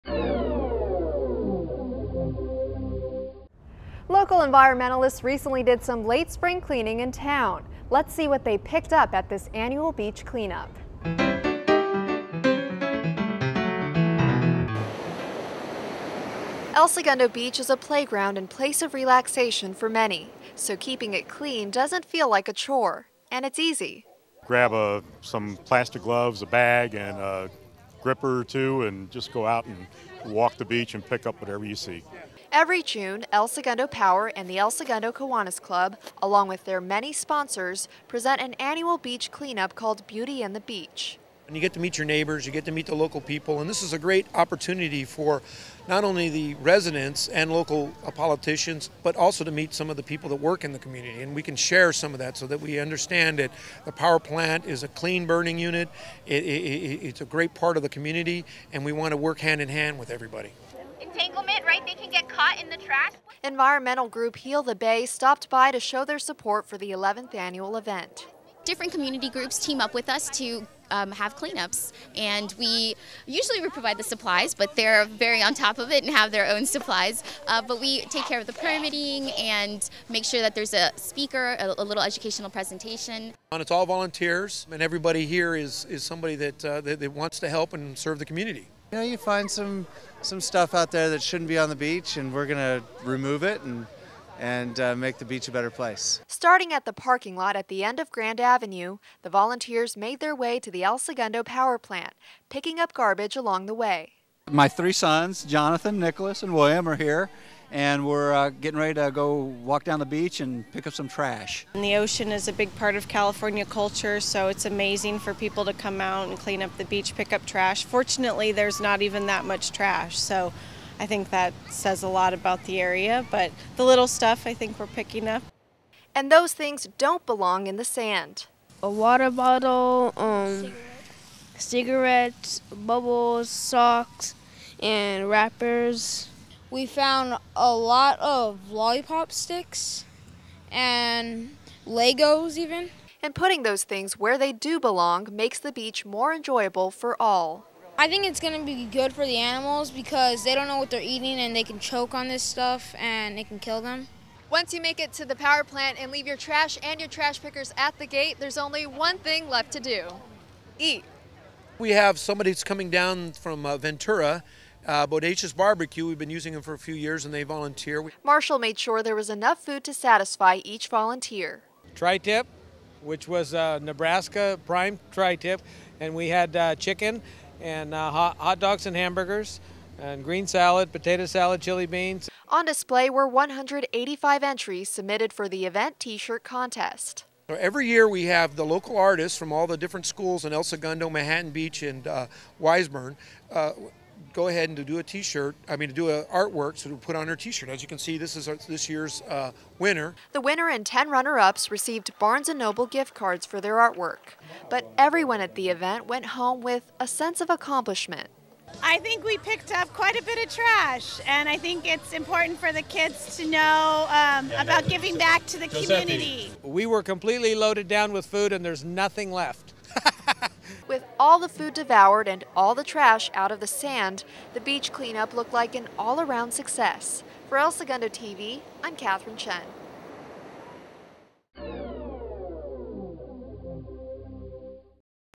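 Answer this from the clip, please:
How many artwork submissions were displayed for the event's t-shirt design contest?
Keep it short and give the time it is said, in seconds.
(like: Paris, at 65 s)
185, at 183 s.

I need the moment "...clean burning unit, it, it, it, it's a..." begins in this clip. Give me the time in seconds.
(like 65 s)
54 s.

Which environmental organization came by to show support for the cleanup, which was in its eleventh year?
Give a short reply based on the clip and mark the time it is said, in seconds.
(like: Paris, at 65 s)
Heal the Bay, at 64 s.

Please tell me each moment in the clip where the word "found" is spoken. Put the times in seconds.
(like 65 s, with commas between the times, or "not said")
136 s.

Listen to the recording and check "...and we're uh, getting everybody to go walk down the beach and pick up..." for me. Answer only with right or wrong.
wrong.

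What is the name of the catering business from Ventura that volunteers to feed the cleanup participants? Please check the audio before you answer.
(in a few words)
Bodacious Barbecue.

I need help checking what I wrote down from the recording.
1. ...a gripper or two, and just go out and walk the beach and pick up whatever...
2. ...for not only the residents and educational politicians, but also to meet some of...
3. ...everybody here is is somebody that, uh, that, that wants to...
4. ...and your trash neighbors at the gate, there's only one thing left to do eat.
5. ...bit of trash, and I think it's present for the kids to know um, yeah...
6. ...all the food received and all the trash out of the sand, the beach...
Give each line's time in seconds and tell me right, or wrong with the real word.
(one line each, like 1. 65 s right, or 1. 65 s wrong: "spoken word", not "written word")
1. 27 s right
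2. 45 s wrong: "local", not "educational"
3. 84 s right
4. 156 s wrong: "pickers", not "neighbors"
5. 210 s wrong: "important", not "present"
6. 221 s wrong: "devoured", not "received".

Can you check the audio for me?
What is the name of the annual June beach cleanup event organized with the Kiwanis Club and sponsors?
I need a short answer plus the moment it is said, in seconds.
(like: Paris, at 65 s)
Beauty and the Beach, at 40 s.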